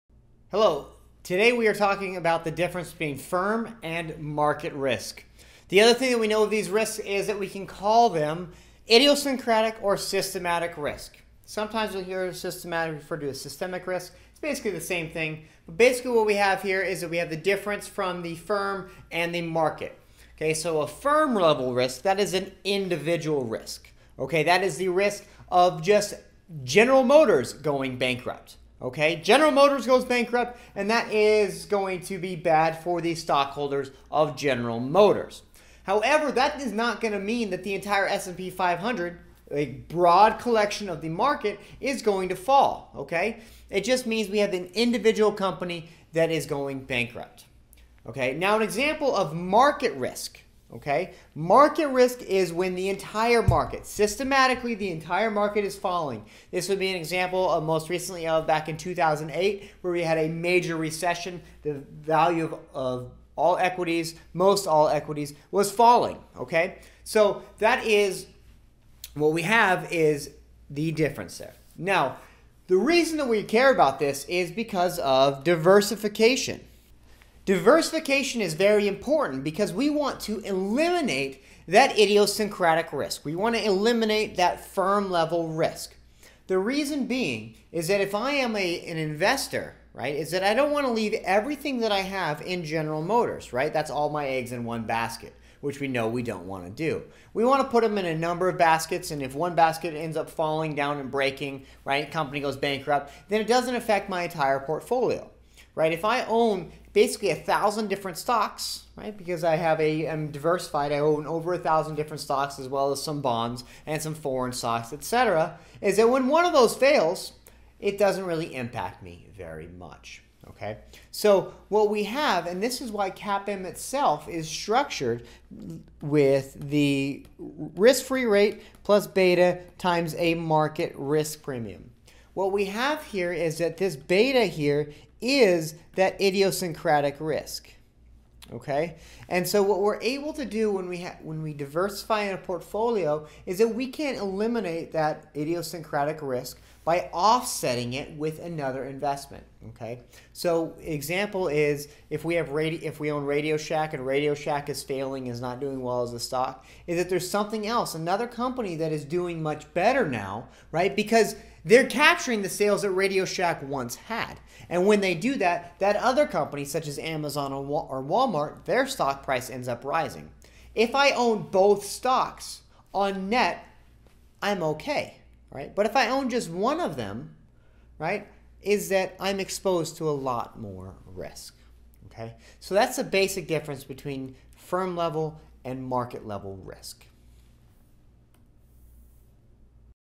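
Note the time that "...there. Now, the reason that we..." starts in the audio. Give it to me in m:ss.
1:11.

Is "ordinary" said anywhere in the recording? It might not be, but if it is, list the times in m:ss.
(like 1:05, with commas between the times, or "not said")
not said.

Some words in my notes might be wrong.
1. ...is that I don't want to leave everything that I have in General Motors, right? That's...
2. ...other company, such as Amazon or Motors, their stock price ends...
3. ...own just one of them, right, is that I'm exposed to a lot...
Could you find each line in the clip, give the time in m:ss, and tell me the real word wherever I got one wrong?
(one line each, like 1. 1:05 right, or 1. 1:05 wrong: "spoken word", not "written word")
1. 1:30 right
2. 2:45 wrong: "Walmart", not "Motors"
3. 2:56 right.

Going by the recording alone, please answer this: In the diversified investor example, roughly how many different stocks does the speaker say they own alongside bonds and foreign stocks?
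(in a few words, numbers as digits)
over a thousand.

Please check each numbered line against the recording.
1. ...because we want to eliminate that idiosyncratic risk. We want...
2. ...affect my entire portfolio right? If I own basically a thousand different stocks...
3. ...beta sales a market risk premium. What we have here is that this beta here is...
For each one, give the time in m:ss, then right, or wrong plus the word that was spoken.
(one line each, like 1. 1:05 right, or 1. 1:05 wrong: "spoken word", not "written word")
1. 1:19 right
2. 1:43 right
3. 2:09 wrong: "times", not "sales".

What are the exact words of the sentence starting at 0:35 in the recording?
However, that is not going to mean that the entire S&P 500, a broad collection of the market, is going to fall.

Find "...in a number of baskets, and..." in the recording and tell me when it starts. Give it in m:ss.
1:37.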